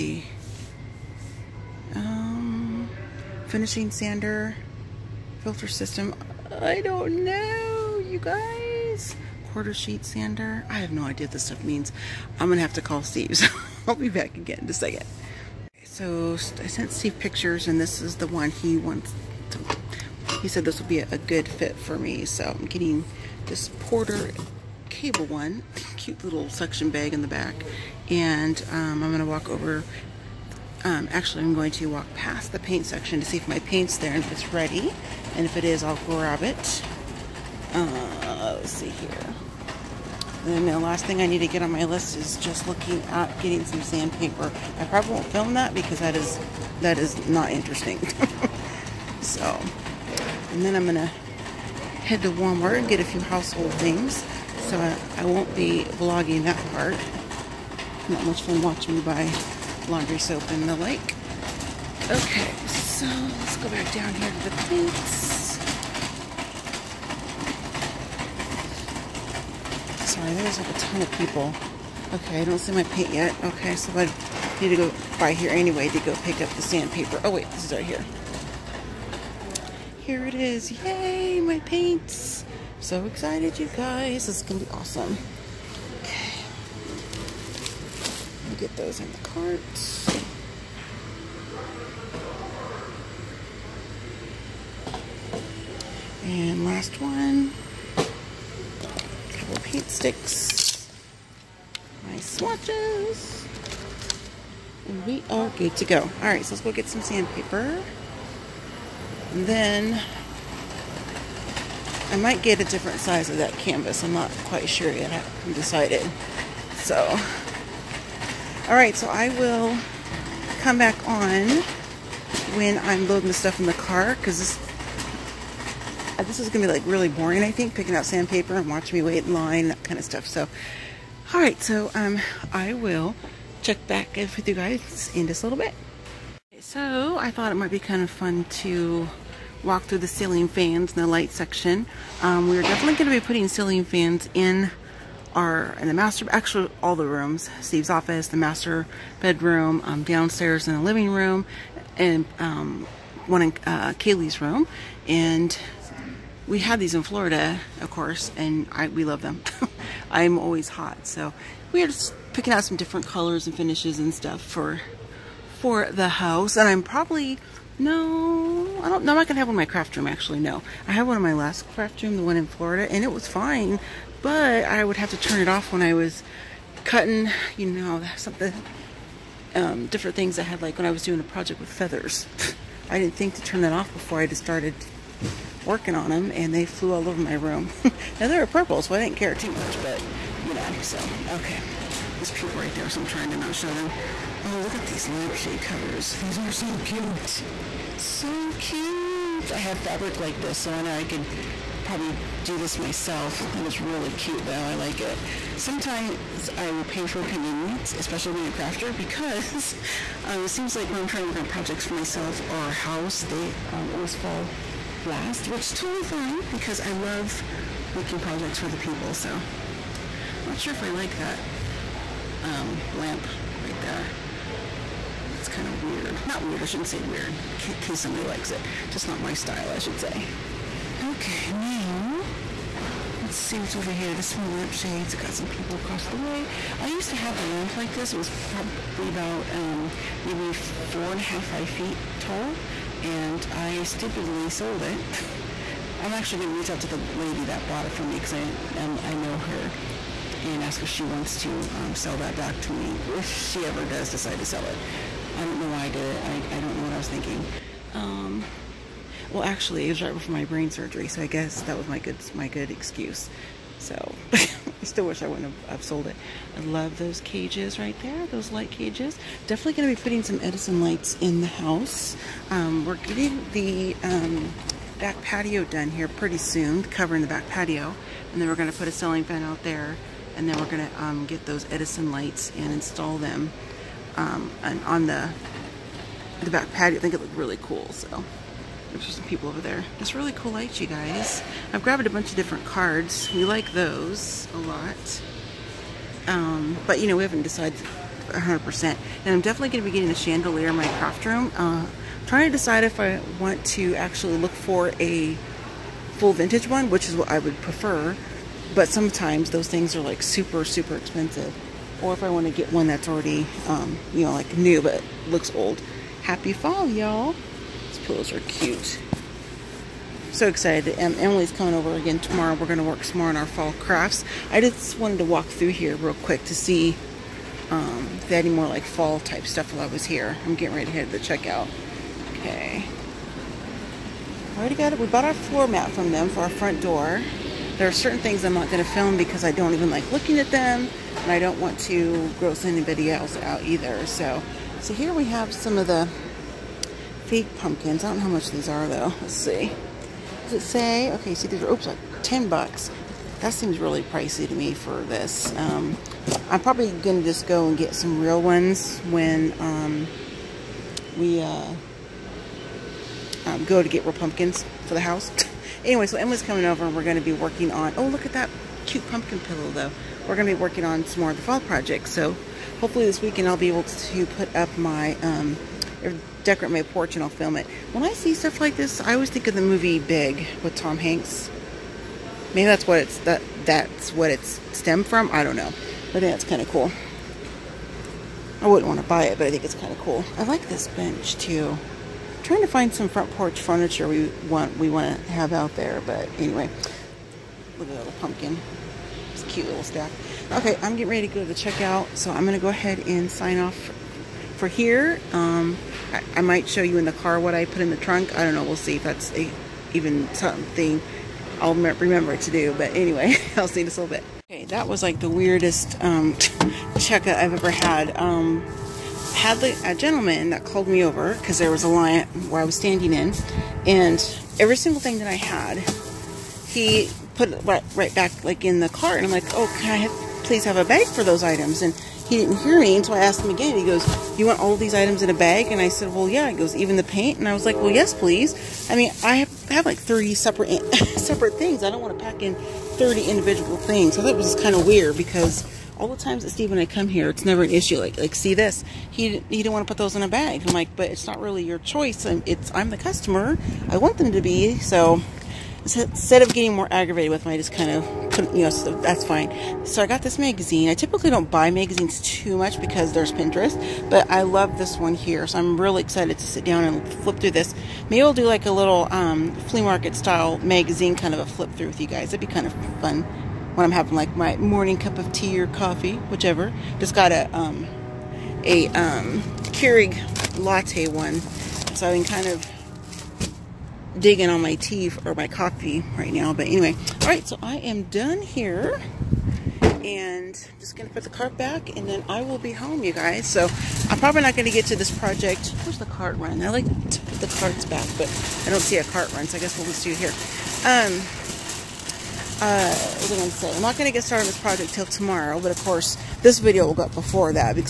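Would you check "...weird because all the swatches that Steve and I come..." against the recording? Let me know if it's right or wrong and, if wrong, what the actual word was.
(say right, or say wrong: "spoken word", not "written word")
wrong: "times", not "swatches".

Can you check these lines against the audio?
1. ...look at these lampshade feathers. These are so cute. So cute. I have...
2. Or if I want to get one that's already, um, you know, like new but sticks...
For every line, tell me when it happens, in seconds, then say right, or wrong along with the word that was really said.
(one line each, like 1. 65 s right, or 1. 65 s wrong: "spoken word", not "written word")
1. 194 s wrong: "covers", not "feathers"
2. 311 s wrong: "looks", not "sticks".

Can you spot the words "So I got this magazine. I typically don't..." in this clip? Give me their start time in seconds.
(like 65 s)
459 s.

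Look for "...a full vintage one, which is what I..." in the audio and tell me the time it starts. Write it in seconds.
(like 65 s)
304 s.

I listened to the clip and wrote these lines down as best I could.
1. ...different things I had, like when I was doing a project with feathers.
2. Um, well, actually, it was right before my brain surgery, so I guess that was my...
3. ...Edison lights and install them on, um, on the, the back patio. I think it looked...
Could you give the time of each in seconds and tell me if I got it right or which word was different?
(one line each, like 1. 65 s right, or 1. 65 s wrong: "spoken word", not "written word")
1. 179 s right
2. 257 s right
3. 281 s right.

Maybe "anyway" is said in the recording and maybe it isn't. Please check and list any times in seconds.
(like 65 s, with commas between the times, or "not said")
75 s, 365 s, 396 s, 412 s, 486 s.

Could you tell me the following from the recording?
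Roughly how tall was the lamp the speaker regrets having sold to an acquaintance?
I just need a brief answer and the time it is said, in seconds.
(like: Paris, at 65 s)
5 feet, at 241 s.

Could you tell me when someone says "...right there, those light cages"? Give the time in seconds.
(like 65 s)
267 s.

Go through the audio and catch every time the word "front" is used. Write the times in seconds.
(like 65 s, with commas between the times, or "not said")
336 s, 393 s.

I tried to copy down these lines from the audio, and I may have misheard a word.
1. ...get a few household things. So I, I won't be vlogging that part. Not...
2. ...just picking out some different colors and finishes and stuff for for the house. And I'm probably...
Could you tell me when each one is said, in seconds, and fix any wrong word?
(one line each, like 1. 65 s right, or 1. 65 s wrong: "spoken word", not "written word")
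1. 52 s right
2. 161 s right.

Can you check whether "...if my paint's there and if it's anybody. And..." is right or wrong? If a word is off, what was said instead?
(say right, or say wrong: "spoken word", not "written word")
wrong: "ready", not "anybody".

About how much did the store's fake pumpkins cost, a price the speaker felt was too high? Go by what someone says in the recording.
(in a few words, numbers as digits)
10 bucks.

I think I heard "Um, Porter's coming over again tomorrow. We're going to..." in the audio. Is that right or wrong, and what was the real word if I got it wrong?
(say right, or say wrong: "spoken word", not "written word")
wrong: "Emily", not "Porter".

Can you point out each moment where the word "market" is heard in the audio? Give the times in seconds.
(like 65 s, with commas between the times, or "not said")
469 s.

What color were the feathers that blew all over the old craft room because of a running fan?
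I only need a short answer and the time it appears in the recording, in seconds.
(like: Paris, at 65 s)
purple, at 188 s.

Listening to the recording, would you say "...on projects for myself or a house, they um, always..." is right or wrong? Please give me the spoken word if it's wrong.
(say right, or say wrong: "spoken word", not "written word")
right.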